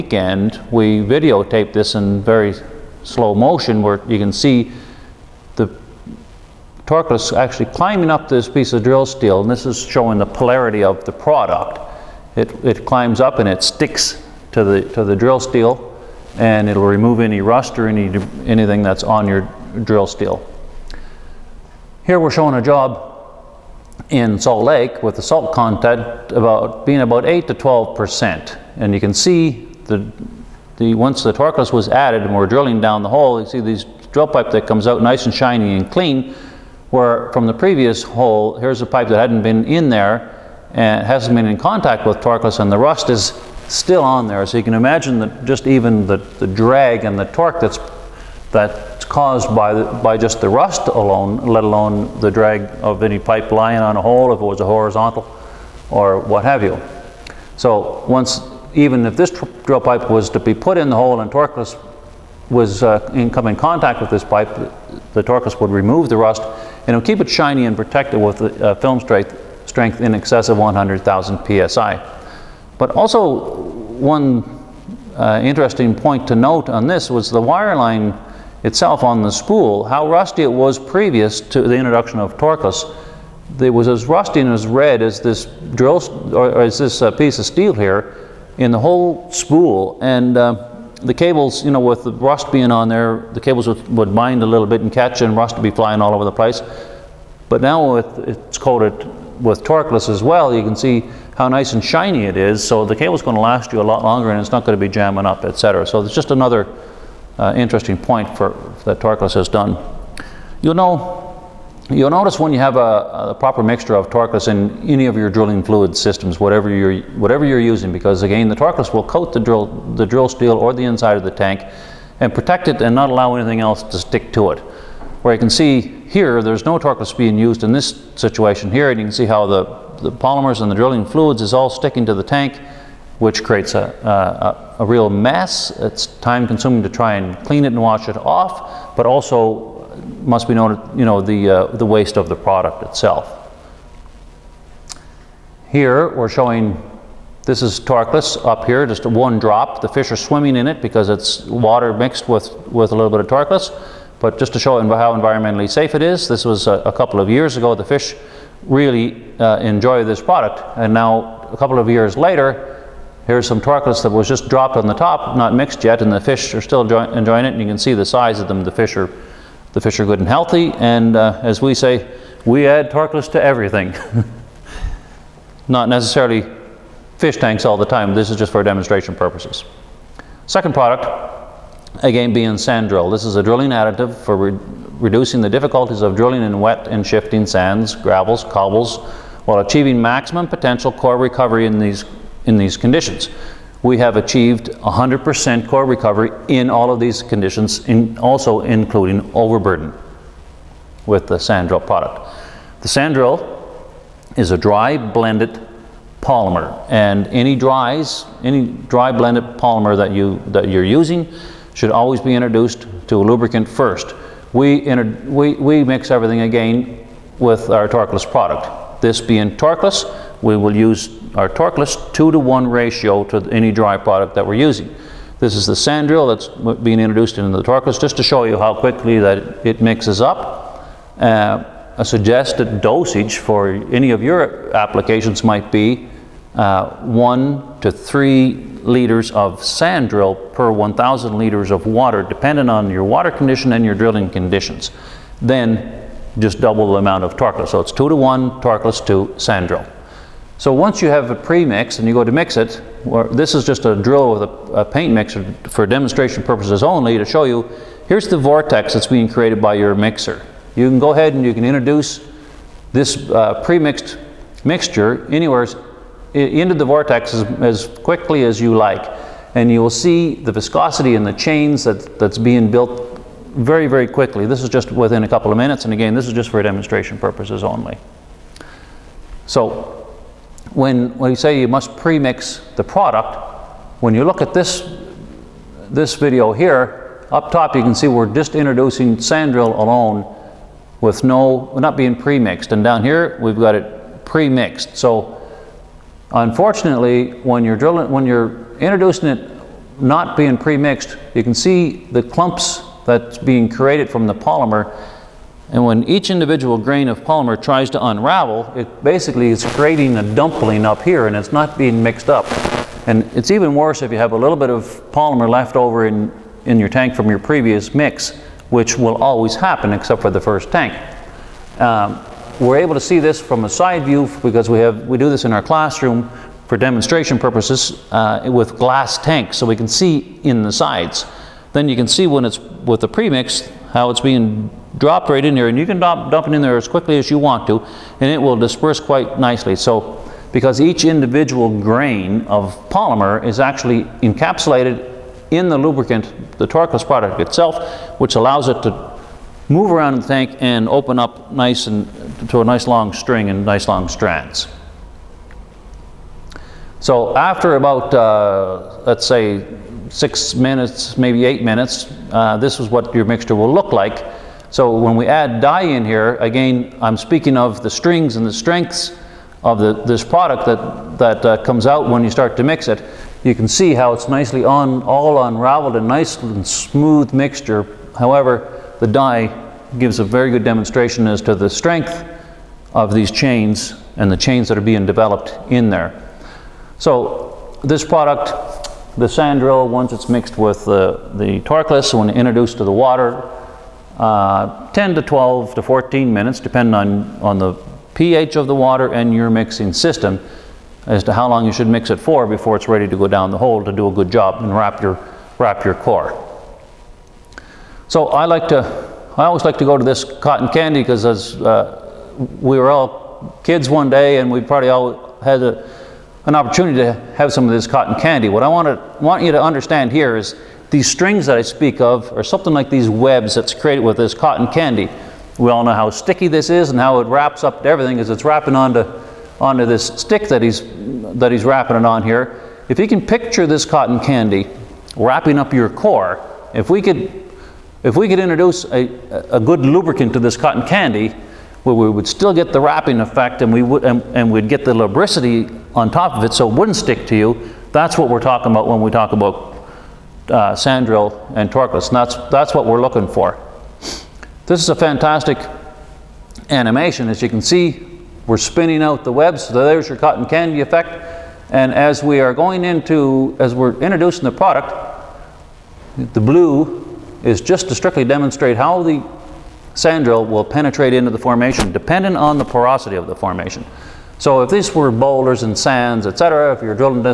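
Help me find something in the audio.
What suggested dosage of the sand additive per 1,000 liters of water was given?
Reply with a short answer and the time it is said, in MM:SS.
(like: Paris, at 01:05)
1 to 3 liters, at 03:57.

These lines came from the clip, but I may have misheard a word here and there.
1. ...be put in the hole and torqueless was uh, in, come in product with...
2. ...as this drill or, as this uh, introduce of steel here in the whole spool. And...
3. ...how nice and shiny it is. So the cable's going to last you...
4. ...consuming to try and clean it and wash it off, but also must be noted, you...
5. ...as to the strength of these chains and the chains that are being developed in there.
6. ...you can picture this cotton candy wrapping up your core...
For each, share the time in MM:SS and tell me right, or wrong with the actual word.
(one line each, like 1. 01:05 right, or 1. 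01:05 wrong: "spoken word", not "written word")
1. 01:00 wrong: "contact", not "product"
2. 01:25 wrong: "piece", not "introduce"
3. 01:41 right
4. 02:16 right
5. 06:21 right
6. 07:12 right.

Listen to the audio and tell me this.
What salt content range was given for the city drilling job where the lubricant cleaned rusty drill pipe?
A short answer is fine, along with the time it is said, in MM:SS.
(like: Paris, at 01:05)
8 to 12 percent, at 00:27.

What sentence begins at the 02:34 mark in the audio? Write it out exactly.
But just to show how environmentally safe it is, this was a, a couple of years ago.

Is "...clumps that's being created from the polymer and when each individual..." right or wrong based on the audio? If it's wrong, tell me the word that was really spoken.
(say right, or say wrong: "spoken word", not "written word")
right.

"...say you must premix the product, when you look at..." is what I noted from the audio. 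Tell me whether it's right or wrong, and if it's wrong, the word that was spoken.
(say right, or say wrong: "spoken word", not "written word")
right.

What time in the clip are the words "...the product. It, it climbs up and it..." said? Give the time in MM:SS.
00:11.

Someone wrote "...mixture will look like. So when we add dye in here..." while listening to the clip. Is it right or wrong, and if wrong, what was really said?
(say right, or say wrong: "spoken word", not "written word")
right.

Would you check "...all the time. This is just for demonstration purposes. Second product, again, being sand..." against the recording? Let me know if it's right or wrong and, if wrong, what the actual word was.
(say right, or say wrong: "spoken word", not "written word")
right.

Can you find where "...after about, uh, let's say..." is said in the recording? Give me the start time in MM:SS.
05:57.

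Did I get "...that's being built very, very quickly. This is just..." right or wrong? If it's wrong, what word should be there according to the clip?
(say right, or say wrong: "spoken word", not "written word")
right.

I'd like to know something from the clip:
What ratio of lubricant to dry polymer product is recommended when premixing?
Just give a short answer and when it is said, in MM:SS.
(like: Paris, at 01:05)
2 to 1, at 03:42.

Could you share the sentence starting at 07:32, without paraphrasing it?
And that's, that's what we're looking for.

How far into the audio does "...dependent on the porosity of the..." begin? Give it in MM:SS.
07:51.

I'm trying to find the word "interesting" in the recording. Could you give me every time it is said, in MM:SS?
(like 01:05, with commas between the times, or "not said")
01:15, 01:47.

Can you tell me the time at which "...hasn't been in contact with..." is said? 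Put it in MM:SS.
00:41.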